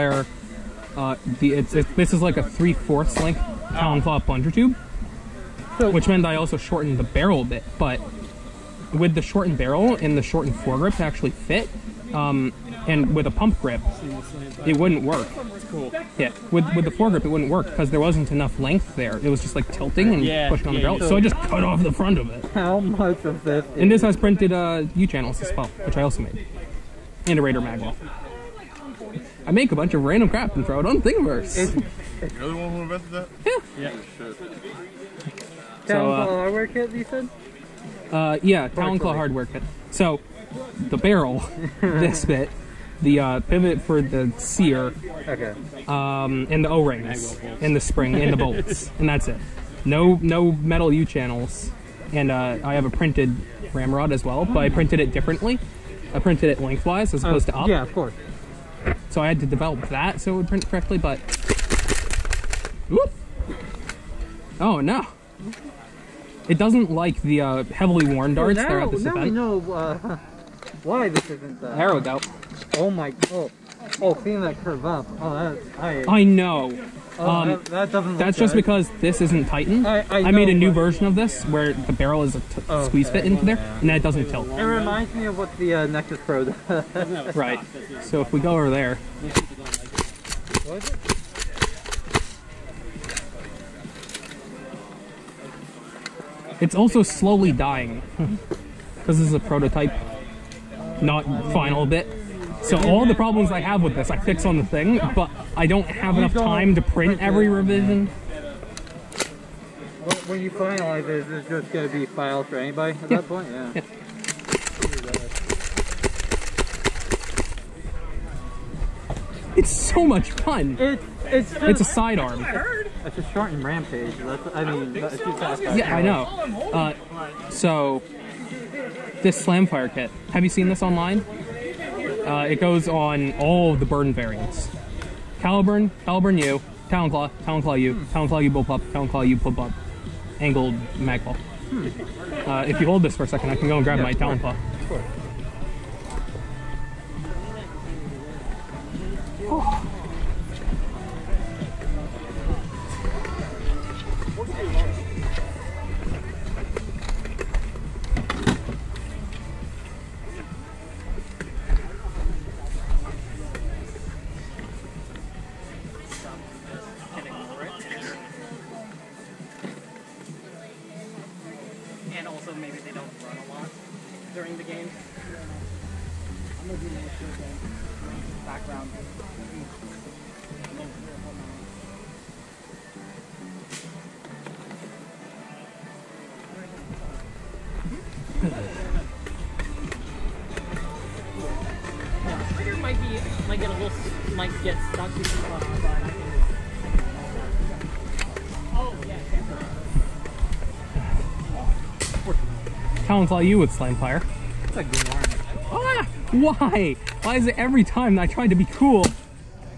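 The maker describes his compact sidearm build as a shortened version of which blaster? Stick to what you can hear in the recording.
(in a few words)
Rampage.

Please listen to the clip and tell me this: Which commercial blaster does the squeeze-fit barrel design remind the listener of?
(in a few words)
Nexus Pro.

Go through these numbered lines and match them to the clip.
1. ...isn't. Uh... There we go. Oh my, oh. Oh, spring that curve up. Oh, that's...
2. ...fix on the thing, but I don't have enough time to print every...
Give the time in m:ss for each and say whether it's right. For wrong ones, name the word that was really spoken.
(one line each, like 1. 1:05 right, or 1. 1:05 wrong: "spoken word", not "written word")
1. 1:11 wrong: "seeing", not "spring"
2. 1:44 right.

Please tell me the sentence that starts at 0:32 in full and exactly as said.
You're the one who invented that?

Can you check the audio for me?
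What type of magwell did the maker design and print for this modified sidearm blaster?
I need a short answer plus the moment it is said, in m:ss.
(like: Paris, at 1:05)
Raider magwell, at 0:27.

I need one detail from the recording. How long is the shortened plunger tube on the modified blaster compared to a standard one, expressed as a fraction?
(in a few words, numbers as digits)
three fourths.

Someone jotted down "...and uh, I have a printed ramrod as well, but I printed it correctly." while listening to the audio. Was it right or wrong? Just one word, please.
wrong.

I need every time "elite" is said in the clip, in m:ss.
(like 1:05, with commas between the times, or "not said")
not said.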